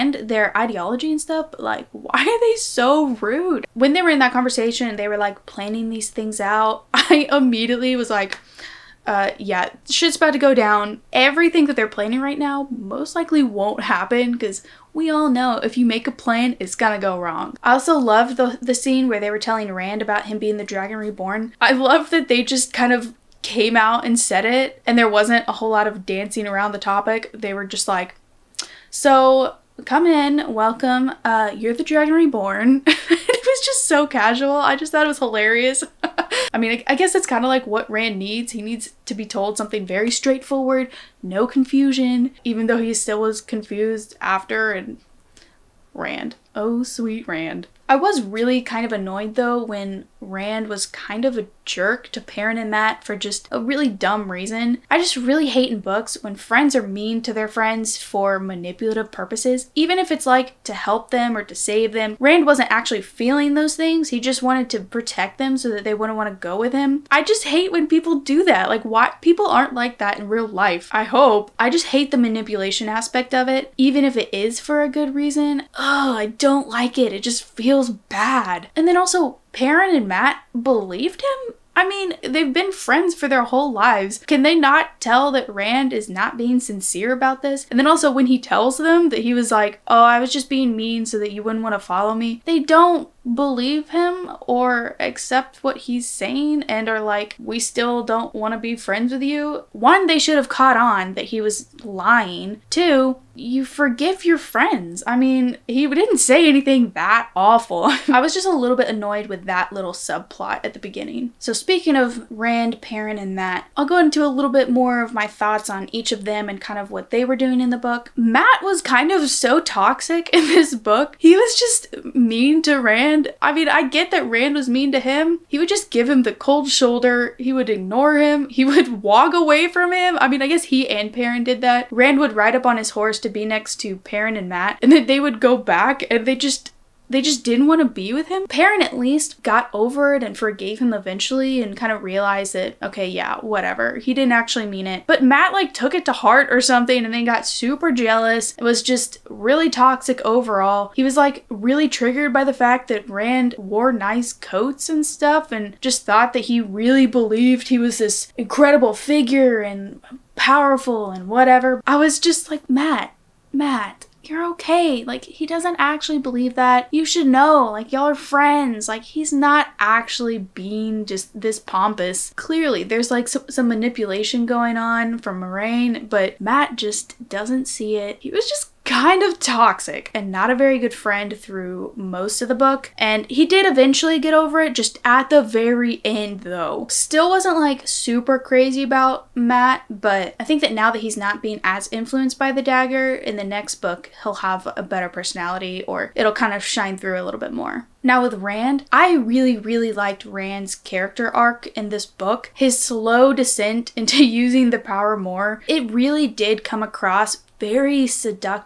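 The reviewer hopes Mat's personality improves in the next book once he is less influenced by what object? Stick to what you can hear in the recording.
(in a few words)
The dagger.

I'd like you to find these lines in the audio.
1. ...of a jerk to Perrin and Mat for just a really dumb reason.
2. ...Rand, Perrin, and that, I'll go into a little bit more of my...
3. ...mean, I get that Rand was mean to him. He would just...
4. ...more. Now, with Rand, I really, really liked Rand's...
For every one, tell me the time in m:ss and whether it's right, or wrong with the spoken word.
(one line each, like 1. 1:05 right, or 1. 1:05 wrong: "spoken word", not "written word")
1. 0:51 right
2. 1:52 right
3. 2:03 right
4. 3:17 right.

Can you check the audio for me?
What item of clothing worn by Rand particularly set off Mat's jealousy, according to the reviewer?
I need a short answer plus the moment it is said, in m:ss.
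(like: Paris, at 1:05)
Nice coats, at 2:33.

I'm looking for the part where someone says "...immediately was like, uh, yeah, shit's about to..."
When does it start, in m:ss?
0:07.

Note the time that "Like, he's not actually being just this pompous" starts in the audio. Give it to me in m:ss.
2:48.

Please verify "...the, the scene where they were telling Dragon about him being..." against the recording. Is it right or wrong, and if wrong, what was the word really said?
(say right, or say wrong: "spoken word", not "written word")
wrong: "Rand", not "Dragon".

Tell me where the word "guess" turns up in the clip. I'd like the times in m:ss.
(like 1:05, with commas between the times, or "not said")
0:36, 2:10.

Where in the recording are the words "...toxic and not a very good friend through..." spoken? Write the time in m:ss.
2:59.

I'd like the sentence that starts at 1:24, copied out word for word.
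Can they not tell that Rand is not being sincere about this?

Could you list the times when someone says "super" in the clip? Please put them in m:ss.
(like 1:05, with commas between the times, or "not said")
2:27, 3:07.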